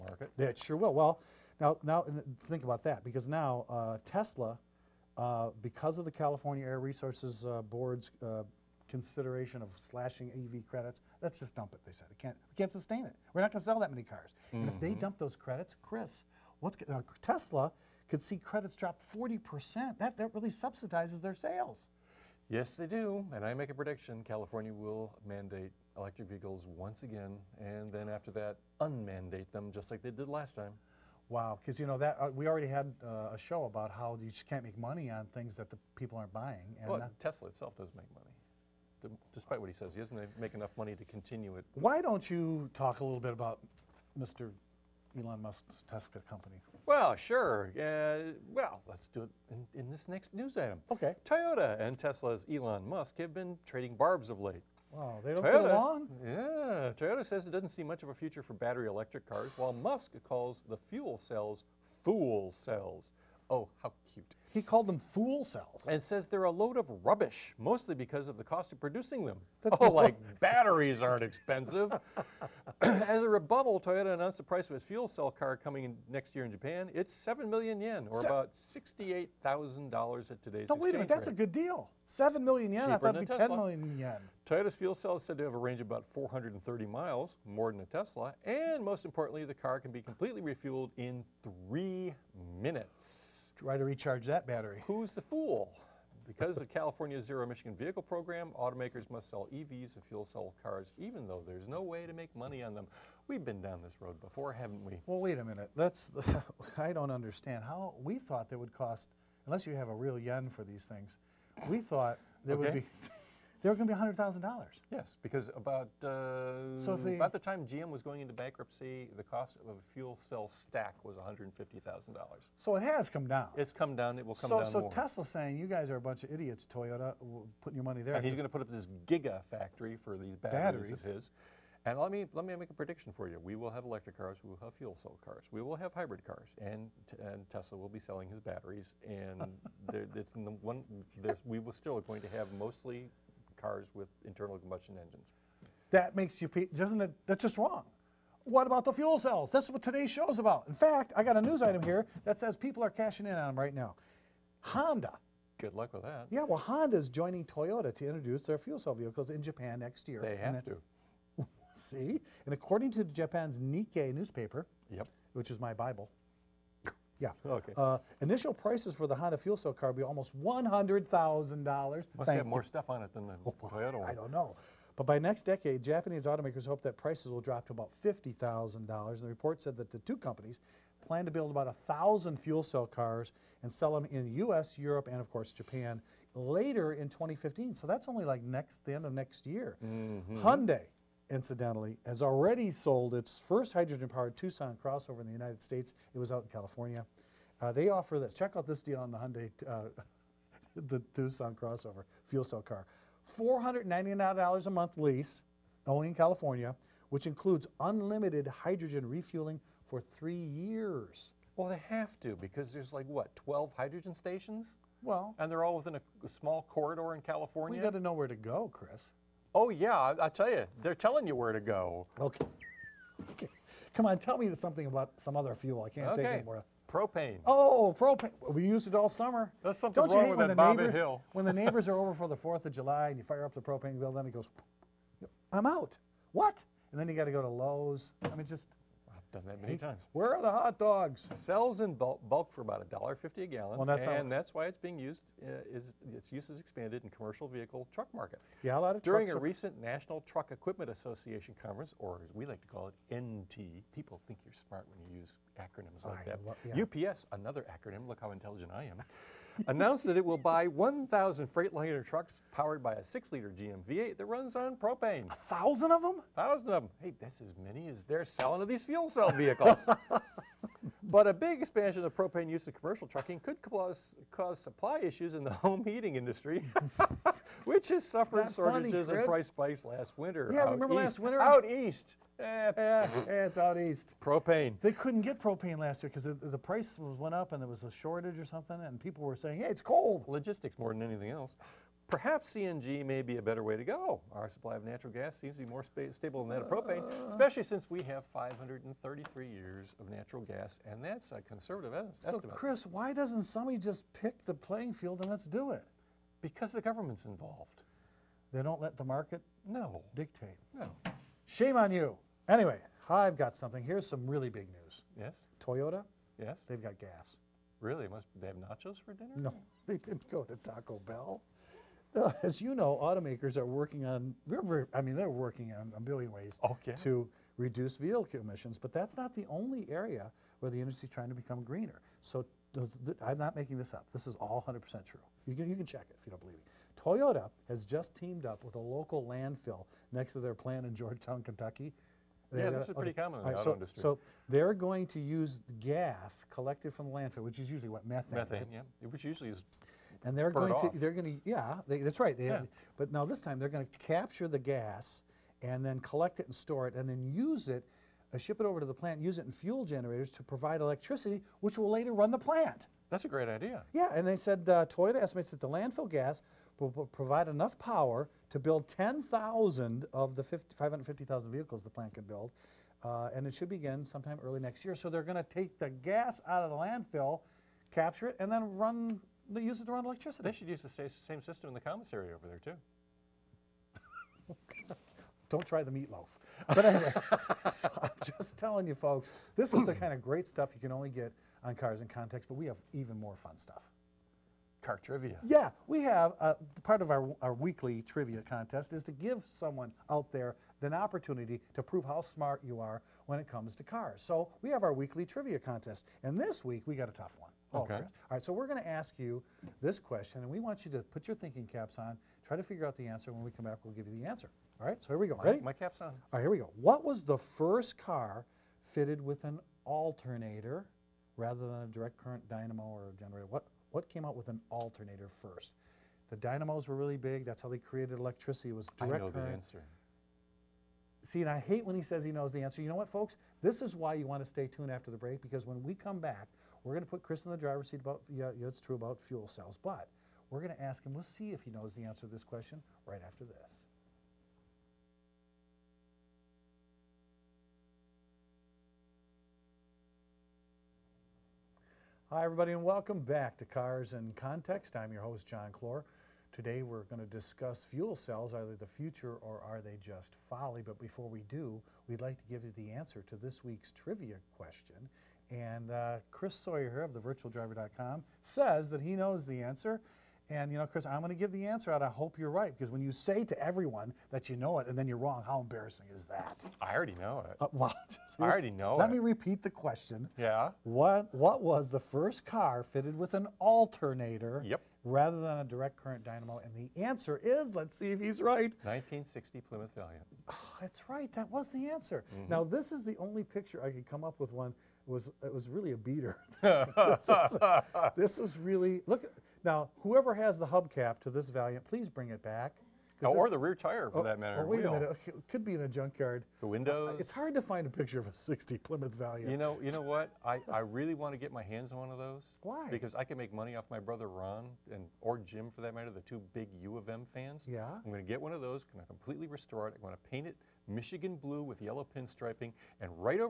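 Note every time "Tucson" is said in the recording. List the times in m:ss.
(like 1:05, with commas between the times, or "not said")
3:14, 3:21.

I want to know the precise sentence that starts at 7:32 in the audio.
Hi, everybody, and welcome back to Cars in Context.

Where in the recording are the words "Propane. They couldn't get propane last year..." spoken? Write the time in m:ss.
4:44.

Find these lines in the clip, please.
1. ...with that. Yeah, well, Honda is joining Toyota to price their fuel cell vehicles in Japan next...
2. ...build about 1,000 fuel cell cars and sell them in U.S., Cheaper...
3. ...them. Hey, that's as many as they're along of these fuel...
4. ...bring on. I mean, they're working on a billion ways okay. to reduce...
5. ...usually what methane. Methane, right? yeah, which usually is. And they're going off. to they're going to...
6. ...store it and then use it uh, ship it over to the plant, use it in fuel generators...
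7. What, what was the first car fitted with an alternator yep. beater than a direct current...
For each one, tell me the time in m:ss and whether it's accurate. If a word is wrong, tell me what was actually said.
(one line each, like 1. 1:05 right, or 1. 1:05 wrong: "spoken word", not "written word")
1. 2:35 wrong: "introduce", not "price"
2. 3:01 wrong: "Europe", not "Cheaper"
3. 4:26 wrong: "selling", not "along"
4. 5:23 wrong: "working", not "bring"
5. 5:47 right
6. 5:56 right
7. 8:00 wrong: "rather", not "beater".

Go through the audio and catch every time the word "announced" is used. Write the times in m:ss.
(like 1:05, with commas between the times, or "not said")
1:14, 4:19.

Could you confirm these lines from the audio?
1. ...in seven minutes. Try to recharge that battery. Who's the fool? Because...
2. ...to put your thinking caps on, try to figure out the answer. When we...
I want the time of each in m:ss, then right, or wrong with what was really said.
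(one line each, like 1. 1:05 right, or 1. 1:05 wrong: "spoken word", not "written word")
1. 1:30 wrong: "three", not "seven"
2. 6:50 right.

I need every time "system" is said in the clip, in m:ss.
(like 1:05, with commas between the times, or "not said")
6:21.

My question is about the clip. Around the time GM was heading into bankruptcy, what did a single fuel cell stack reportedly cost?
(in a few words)
$150,000.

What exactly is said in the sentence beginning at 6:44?
So we have our weekly trivia contest, and this week we got a tough one.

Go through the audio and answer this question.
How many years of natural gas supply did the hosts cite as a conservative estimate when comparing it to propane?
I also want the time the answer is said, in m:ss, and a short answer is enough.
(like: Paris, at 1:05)
533 years, at 4:58.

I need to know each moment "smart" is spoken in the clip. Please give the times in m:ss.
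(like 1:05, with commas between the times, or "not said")
4:14, 6:42.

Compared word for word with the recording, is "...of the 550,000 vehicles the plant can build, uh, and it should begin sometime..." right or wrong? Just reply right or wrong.
right.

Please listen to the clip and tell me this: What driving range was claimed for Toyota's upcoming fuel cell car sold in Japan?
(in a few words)
430 miles.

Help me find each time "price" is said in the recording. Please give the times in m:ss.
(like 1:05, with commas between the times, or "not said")
1:14, 2:48, 2:56, 4:39, 4:46.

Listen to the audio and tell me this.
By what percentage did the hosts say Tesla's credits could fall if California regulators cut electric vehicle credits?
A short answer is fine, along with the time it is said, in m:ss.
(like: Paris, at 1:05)
40 percent, at 0:19.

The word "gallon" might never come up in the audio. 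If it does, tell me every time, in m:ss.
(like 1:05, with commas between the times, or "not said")
4:03.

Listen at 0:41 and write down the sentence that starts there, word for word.
Why don't you talk a little bit about Mr.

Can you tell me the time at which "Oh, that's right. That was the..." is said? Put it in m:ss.
8:10.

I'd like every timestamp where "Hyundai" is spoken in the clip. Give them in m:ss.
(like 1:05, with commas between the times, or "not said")
3:10, 3:19.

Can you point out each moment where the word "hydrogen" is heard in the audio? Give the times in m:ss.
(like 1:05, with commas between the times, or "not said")
3:13, 3:28, 3:33.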